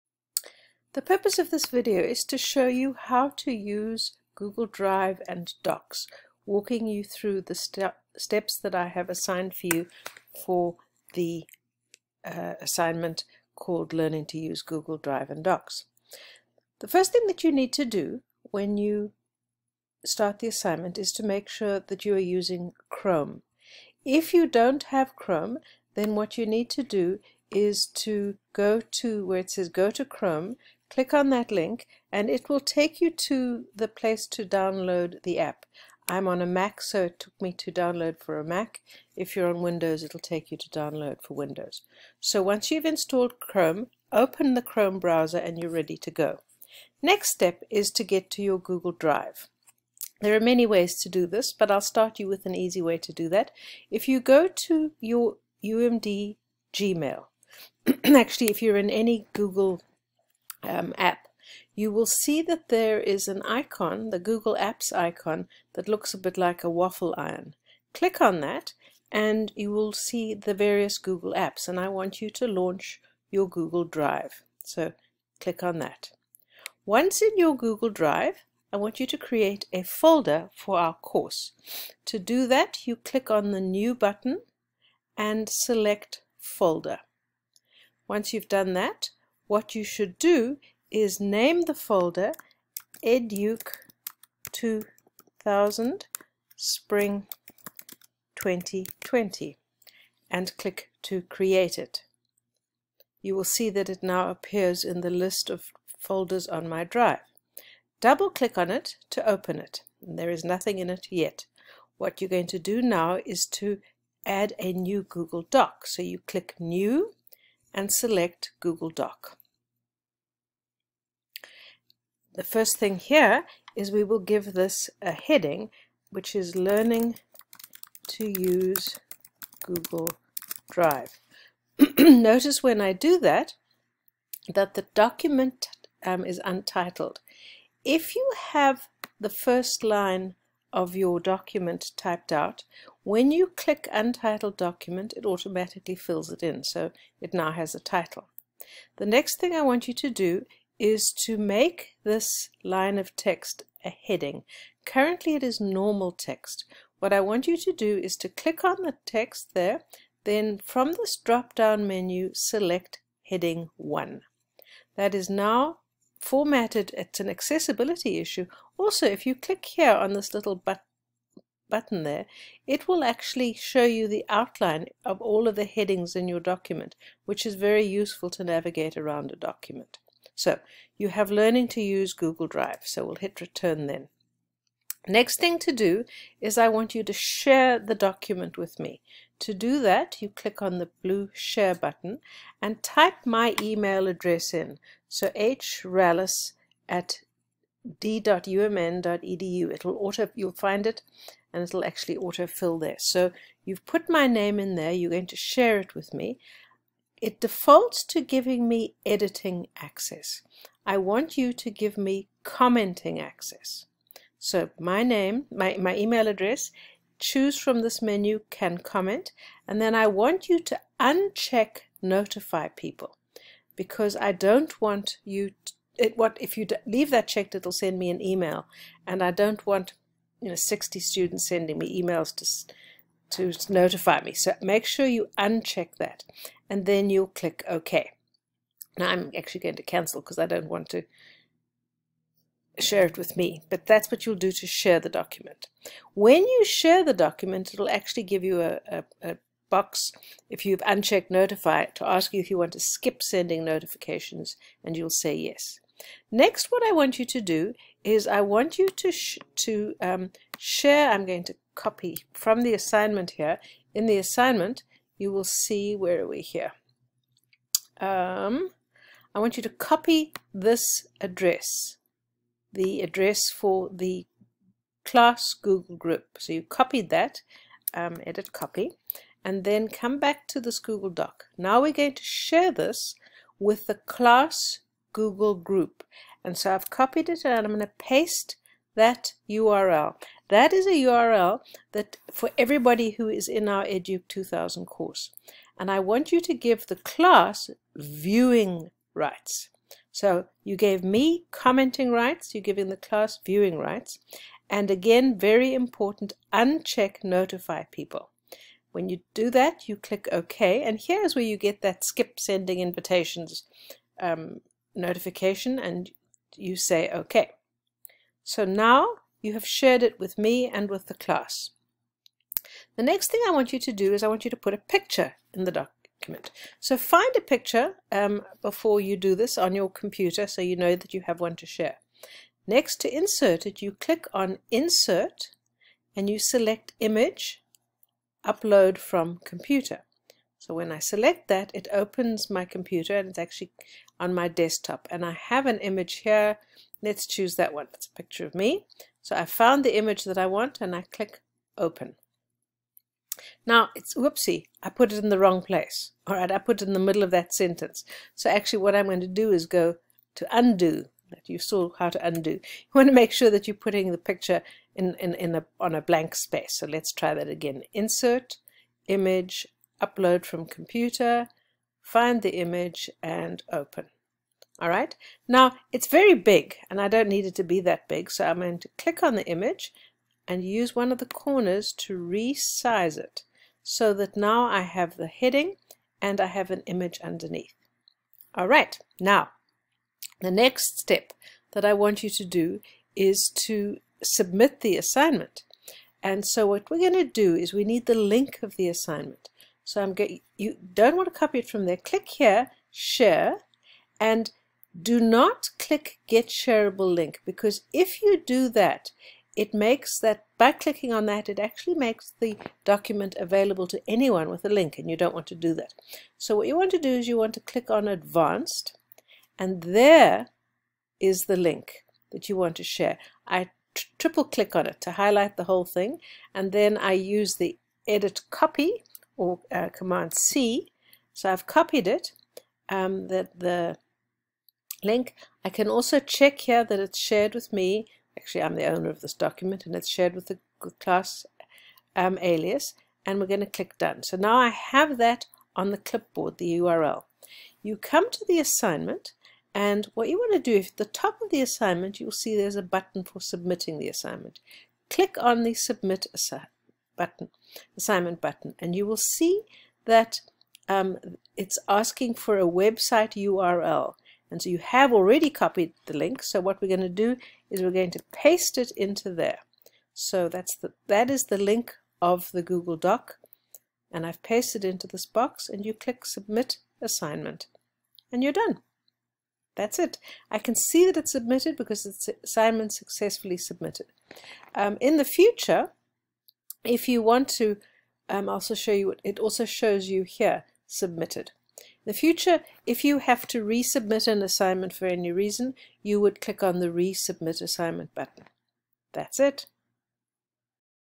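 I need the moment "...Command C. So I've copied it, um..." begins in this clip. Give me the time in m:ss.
7:09.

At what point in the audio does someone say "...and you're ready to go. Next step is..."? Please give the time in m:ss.
0:45.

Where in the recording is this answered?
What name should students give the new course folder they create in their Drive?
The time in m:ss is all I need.
1:33.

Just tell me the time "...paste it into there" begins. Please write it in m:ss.
7:48.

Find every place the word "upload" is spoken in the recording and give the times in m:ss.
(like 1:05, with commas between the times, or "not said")
5:38, 6:10.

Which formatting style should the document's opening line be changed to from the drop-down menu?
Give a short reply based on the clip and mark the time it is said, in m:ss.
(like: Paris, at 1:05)
Heading 1, at 2:43.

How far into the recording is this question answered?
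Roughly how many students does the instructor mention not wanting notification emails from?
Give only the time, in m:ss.
3:50.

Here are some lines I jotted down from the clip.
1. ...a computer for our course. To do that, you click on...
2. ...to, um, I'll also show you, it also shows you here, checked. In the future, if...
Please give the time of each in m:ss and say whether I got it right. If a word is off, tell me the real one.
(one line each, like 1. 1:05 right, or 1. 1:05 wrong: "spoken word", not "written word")
1. 1:19 wrong: "folder", not "computer"
2. 8:07 wrong: "submitted", not "checked".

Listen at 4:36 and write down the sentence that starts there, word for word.
So you copied that, um, edit copy, and then come back to this Google Doc.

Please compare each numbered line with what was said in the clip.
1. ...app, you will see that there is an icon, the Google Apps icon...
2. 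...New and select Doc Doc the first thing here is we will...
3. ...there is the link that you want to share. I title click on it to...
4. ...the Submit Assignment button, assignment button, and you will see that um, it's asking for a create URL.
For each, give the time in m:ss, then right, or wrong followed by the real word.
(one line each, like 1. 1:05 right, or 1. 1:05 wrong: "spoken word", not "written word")
1. 1:00 right
2. 1:56 wrong: "Google", not "Doc"
3. 6:59 wrong: "triple", not "title"
4. 7:35 wrong: "website", not "create".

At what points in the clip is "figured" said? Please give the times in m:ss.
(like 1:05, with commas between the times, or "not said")
not said.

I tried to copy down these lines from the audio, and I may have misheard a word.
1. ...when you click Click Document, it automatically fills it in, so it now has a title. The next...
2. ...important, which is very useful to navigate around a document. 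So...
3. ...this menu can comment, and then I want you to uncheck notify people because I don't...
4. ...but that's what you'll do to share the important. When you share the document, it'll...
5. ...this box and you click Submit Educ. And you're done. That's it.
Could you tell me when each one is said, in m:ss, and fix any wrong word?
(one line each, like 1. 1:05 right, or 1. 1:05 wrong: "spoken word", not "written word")
1. 2:23 wrong: "Untitled", not "Click"
2. 2:56 wrong: "document", not "important"
3. 3:37 right
4. 4:03 wrong: "document", not "important"
5. 7:55 wrong: "Assignment", not "Educ".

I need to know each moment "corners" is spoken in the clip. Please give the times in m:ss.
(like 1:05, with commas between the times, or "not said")
6:21.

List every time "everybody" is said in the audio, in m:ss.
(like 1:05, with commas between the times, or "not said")
4:52.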